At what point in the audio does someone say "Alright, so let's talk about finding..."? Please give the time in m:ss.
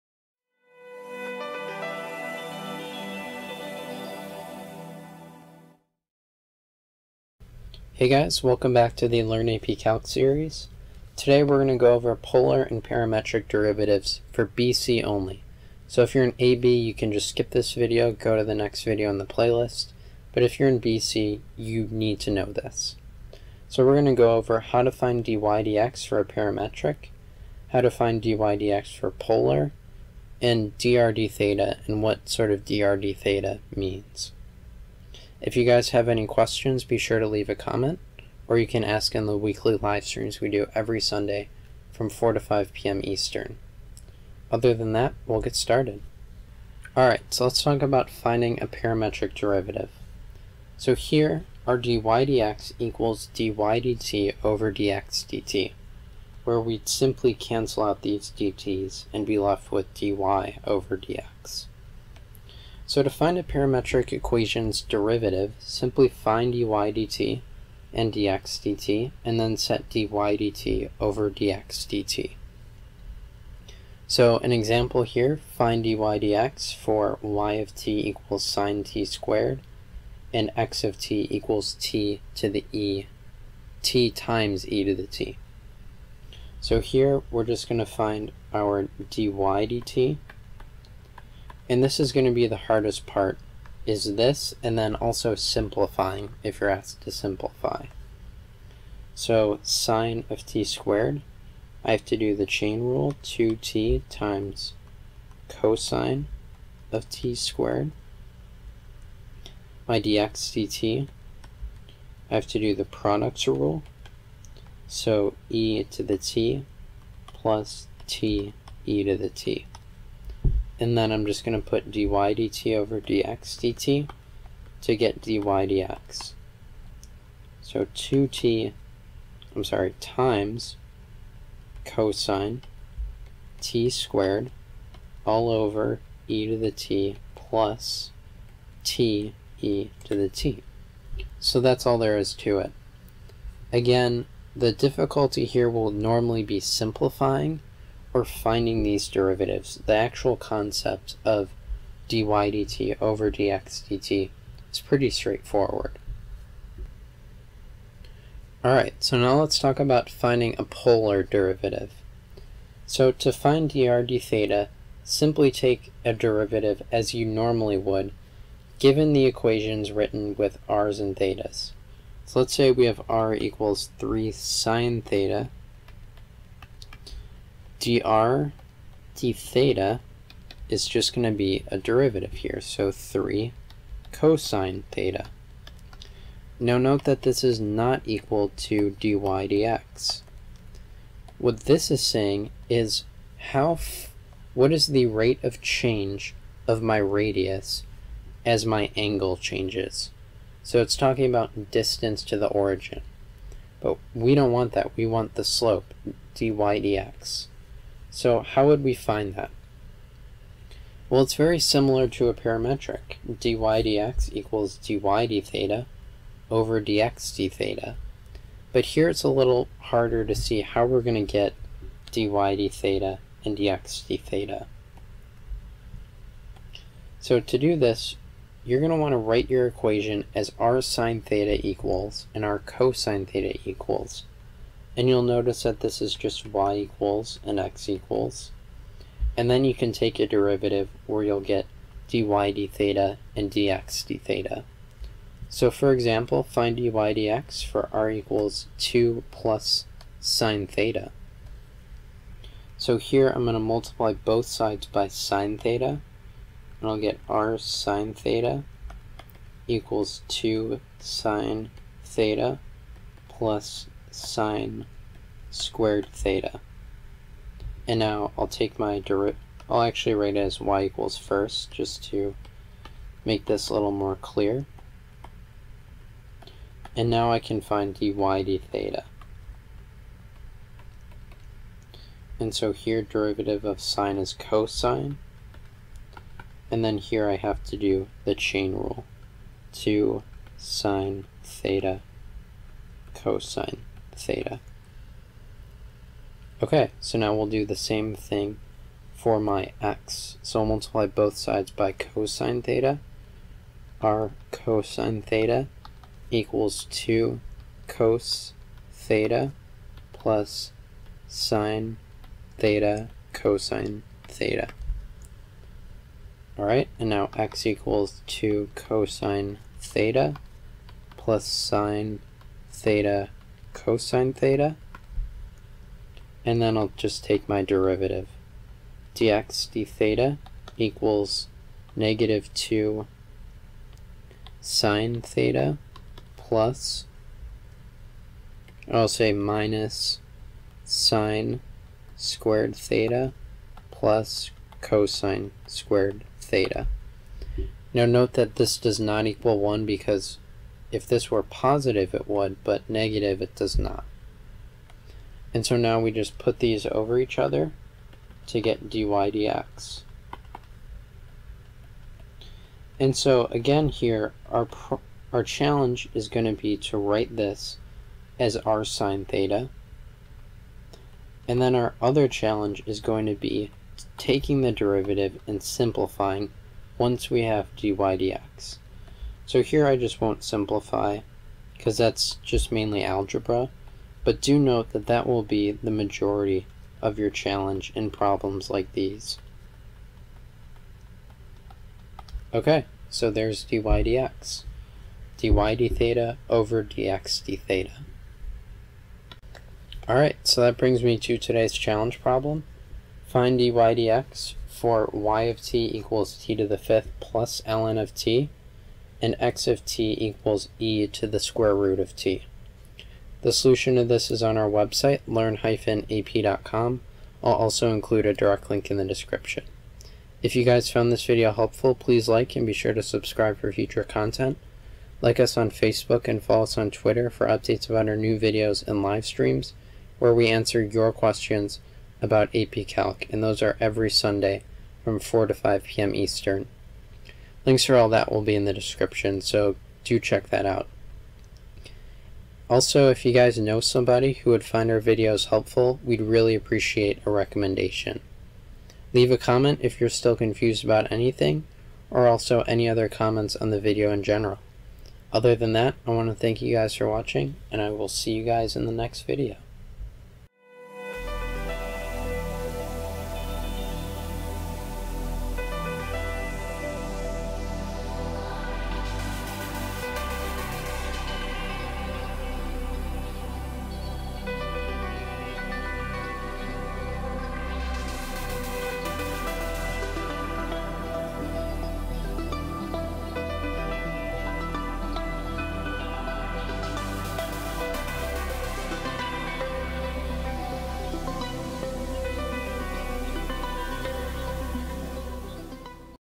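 0:46.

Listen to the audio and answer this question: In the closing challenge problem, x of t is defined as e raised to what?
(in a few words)
square root of t.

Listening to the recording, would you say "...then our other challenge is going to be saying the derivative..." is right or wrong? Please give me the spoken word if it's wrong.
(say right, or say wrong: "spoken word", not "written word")
wrong: "taking", not "saying".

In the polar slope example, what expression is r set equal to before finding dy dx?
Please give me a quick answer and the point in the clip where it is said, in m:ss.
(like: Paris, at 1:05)
2 plus sine theta, at 4:08.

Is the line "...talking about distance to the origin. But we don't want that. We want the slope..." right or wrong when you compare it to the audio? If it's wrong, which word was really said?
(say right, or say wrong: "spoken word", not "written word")
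right.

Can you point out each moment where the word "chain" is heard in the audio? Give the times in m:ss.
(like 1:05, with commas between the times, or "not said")
1:42, 4:48.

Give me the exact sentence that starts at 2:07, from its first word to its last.
So 2t, I'm sorry, times cosine t squared all over e to the t plus t e to the t.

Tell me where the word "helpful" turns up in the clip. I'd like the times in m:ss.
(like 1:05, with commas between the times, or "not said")
7:01, 7:25.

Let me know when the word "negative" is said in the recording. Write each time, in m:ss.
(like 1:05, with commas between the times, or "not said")
5:31, 5:52.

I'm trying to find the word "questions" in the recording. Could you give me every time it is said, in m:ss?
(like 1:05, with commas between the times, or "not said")
0:36, 7:11.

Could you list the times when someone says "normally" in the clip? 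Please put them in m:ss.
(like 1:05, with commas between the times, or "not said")
2:25, 2:47.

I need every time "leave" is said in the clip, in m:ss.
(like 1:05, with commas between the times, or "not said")
0:37, 7:29.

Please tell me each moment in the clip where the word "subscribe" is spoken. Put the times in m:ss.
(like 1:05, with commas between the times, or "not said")
7:03.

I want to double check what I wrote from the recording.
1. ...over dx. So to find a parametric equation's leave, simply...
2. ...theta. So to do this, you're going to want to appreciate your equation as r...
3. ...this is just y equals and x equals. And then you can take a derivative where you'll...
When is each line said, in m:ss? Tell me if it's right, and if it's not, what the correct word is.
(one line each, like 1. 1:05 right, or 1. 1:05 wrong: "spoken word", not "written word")
1. 1:00 wrong: "derivative", not "leave"
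2. 3:44 wrong: "write", not "appreciate"
3. 3:55 right.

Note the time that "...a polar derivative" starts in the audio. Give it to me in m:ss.
2:40.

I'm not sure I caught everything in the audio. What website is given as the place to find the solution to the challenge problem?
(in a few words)
learn-ap.com.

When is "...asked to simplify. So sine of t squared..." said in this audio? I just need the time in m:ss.
1:36.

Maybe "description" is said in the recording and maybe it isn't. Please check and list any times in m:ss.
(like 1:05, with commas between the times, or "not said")
6:59, 7:18.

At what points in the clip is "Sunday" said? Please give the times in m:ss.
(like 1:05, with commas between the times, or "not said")
0:41, 7:14.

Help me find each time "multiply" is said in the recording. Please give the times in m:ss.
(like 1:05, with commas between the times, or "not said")
4:13, 5:00.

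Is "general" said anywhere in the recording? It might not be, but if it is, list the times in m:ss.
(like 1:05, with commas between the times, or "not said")
7:34.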